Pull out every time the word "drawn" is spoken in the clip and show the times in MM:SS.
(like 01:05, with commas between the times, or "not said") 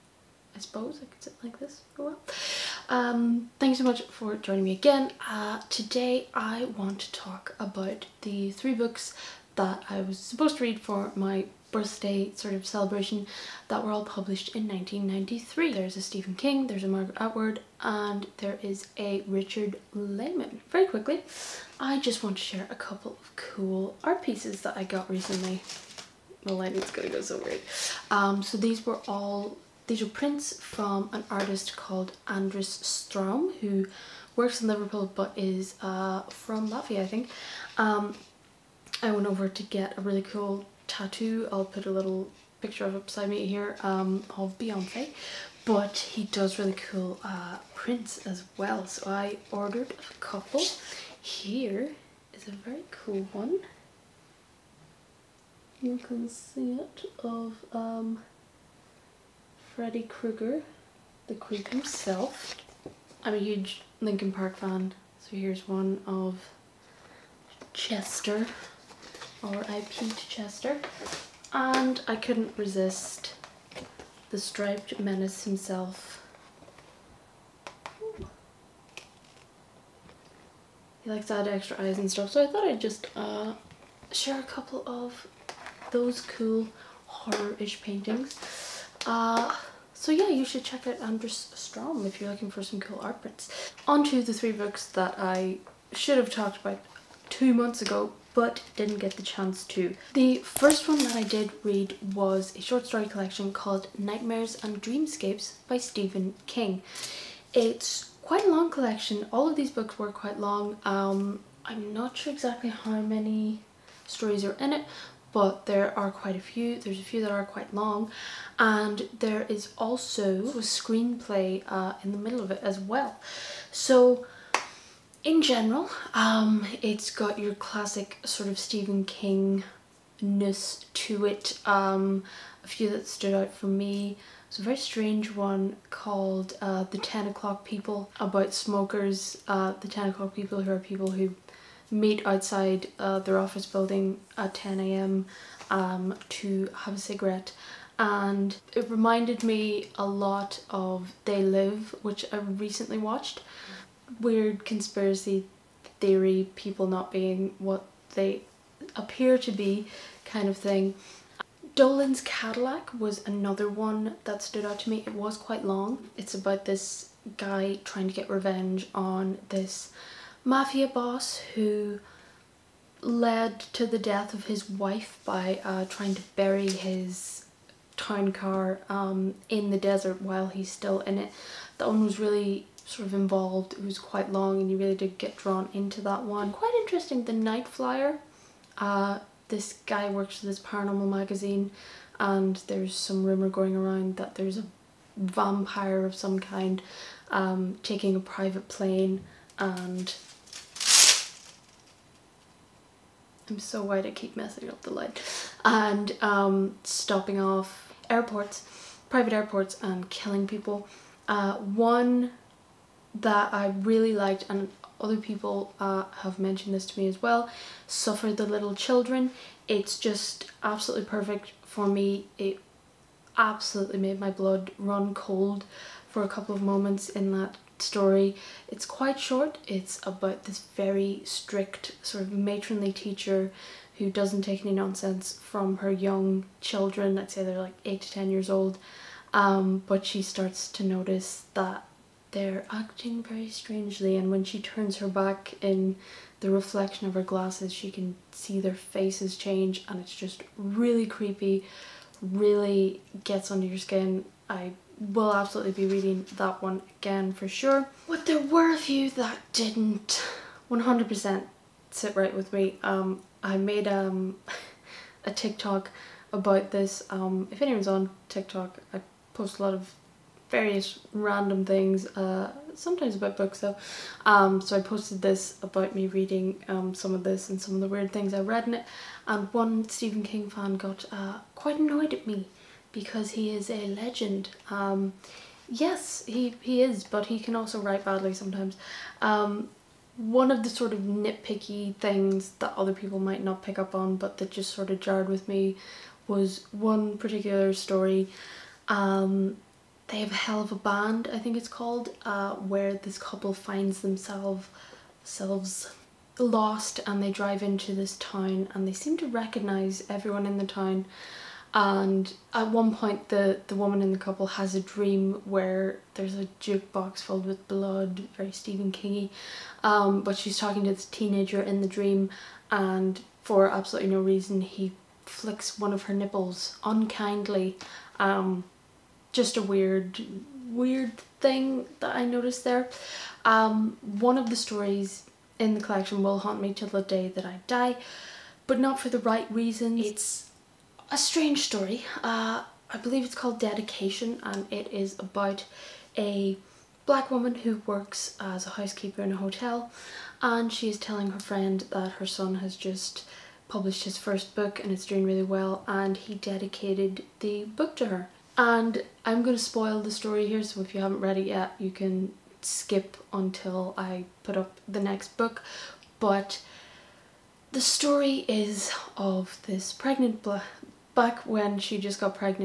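03:05.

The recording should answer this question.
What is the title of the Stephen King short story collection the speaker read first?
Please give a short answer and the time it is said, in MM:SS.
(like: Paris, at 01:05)
Nightmares and Dreamscapes, at 01:43.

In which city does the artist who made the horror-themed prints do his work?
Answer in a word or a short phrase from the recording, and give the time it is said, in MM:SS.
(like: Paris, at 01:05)
Liverpool, at 00:34.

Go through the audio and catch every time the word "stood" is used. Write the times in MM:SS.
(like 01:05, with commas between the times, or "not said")
02:13, 02:44.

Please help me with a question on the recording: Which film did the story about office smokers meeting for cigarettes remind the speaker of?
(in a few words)
They Live.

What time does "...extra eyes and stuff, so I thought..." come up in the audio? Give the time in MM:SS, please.
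01:21.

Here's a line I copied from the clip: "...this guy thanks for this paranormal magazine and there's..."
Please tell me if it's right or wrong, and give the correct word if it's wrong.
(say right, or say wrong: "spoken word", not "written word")
wrong: "works", not "thanks".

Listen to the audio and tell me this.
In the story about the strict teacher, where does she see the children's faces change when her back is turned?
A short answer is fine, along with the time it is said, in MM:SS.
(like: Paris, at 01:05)
her glasses, at 04:07.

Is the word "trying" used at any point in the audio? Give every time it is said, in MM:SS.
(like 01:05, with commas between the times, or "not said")
02:47, 02:55.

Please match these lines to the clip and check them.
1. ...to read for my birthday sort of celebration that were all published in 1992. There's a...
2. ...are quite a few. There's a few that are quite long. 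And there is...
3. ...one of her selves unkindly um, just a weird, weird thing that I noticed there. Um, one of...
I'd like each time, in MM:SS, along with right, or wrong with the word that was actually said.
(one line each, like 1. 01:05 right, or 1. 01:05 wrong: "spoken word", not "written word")
1. 00:10 wrong: "1993", not "1992"
2. 01:55 right
3. 05:25 wrong: "nipples", not "selves".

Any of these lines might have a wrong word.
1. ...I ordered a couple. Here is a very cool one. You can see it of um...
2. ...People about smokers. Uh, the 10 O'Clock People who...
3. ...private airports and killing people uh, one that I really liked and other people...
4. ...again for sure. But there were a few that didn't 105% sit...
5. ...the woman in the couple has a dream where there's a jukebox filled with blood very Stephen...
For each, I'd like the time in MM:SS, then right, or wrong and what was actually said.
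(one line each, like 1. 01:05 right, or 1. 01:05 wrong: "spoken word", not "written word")
1. 00:49 right
2. 02:17 right
3. 03:29 right
4. 04:16 wrong: "100", not "105"
5. 05:13 right.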